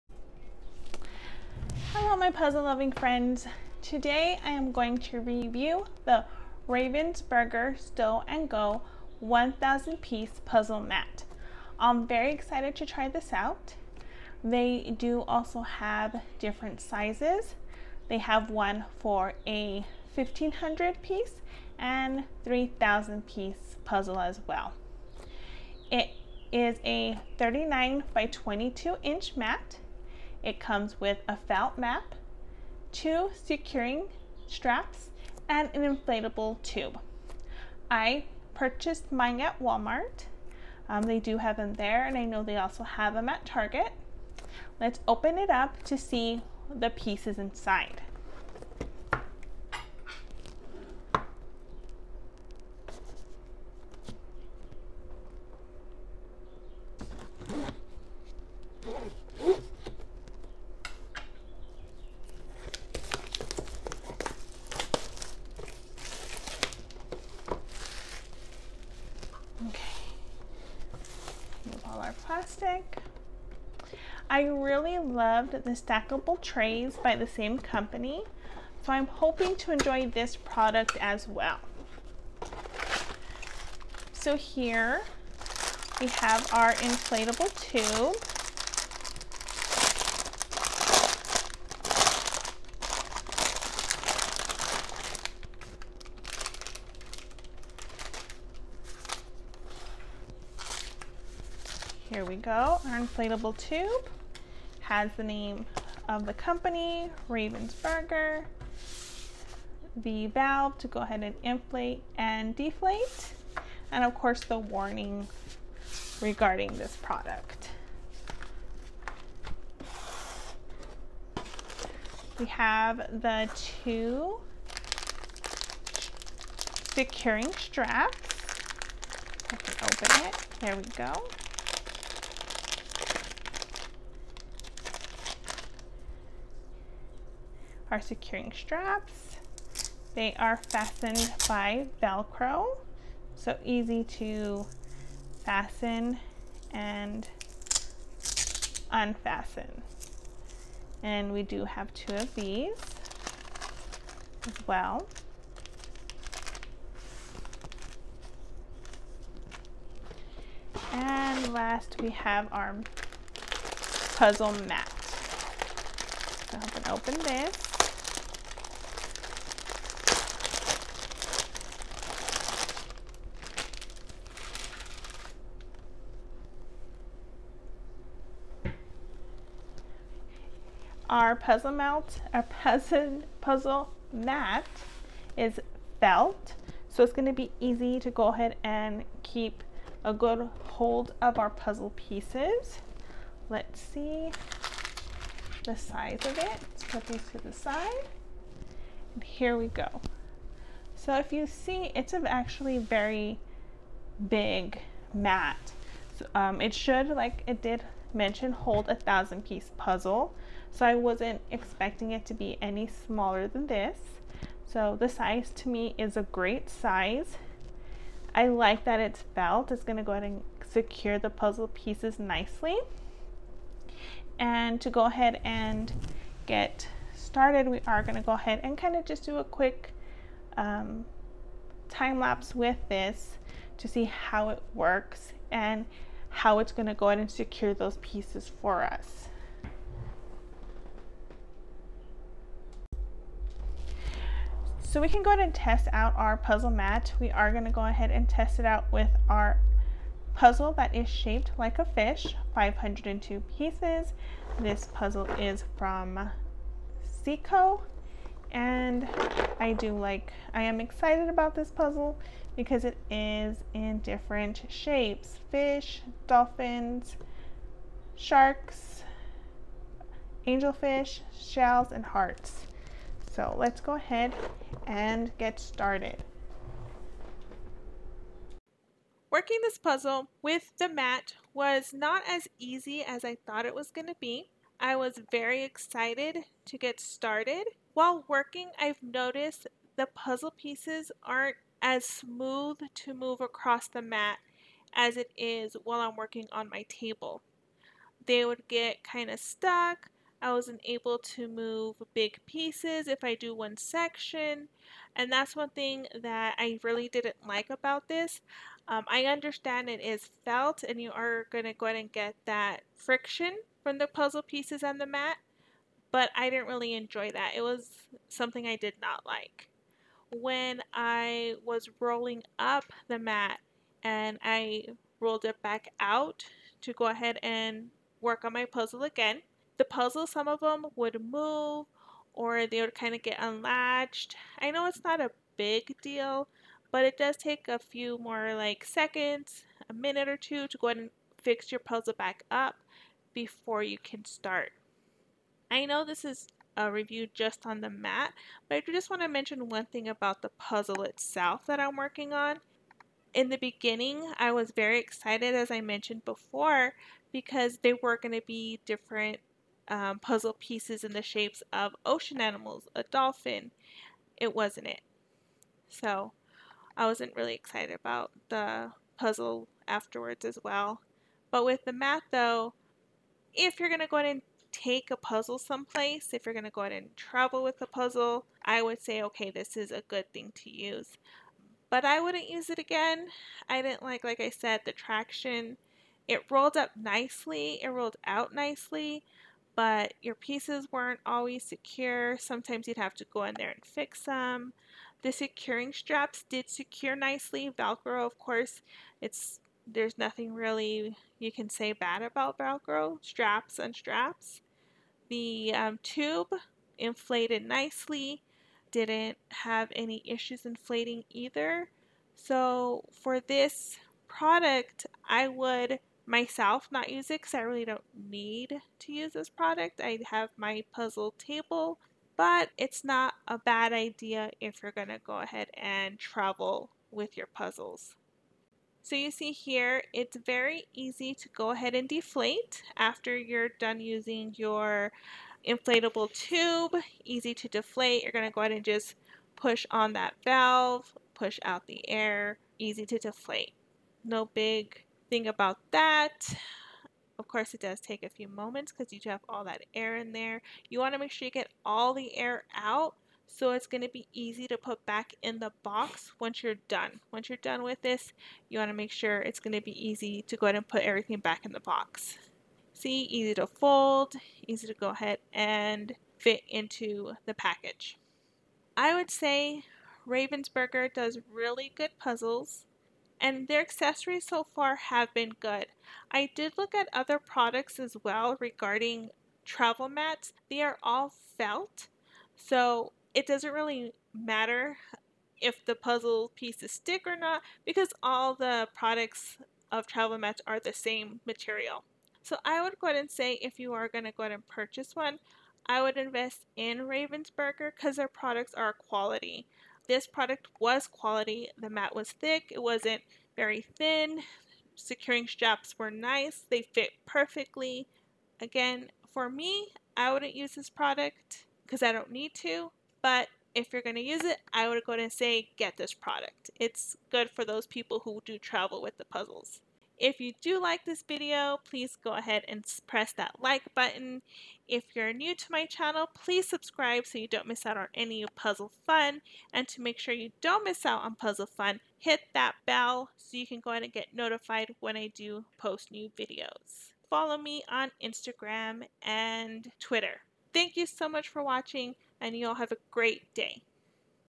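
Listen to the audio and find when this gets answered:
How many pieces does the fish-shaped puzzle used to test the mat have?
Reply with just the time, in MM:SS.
04:12.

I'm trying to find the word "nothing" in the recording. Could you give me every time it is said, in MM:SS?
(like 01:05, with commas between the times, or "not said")
06:40.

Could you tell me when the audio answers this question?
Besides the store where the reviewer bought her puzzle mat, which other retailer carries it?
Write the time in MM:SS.
00:43.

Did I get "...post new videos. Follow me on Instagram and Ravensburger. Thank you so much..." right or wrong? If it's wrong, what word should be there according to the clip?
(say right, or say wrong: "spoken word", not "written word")
wrong: "Twitter", not "Ravensburger".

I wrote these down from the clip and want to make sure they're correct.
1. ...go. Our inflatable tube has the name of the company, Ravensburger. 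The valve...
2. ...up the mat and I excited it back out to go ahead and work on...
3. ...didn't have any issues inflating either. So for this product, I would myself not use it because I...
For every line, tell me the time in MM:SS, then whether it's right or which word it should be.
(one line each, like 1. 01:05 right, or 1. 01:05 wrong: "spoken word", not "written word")
1. 01:42 right
2. 05:22 wrong: "rolled", not "excited"
3. 06:48 right.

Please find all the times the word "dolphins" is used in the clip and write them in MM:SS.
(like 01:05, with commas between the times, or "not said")
04:26, 06:03.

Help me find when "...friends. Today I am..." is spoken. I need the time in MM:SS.
00:02.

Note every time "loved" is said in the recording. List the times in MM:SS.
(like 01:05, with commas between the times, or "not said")
01:14.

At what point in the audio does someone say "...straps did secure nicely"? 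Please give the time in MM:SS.
06:35.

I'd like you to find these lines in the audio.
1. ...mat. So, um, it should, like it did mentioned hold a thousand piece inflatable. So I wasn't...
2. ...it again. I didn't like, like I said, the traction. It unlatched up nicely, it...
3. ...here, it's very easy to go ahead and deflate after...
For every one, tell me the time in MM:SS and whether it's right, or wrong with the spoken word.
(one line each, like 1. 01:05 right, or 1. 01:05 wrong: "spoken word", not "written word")
1. 03:25 wrong: "puzzle", not "inflatable"
2. 06:22 wrong: "rolled", not "unlatched"
3. 07:09 right.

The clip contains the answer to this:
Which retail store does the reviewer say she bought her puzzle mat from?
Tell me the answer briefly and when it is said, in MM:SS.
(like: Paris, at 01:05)
Walmart, at 00:39.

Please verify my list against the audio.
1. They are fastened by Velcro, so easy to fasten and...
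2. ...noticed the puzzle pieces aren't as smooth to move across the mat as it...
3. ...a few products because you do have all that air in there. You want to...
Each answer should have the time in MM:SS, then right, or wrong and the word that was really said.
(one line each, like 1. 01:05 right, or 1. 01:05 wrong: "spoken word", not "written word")
1. 02:20 right
2. 04:49 right
3. 07:28 wrong: "moments", not "products".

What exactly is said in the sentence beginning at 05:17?
It was something I did not like.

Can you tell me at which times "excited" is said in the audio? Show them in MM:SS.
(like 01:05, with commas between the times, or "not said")
00:12, 04:20, 04:45, 05:54, 06:07.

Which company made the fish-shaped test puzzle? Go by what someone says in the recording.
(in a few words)
Ceaco.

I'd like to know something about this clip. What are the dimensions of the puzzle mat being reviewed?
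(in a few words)
39 by 22 inches.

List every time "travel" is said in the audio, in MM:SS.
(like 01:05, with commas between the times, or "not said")
06:17, 07:06, 07:59, 08:10, 08:38.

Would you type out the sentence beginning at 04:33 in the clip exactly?
So let's go ahead and get started.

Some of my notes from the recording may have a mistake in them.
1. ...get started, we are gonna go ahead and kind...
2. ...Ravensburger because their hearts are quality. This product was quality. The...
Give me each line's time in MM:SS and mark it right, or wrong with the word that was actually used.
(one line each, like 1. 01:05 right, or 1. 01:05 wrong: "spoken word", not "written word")
1. 03:46 right
2. 08:16 wrong: "products", not "hearts".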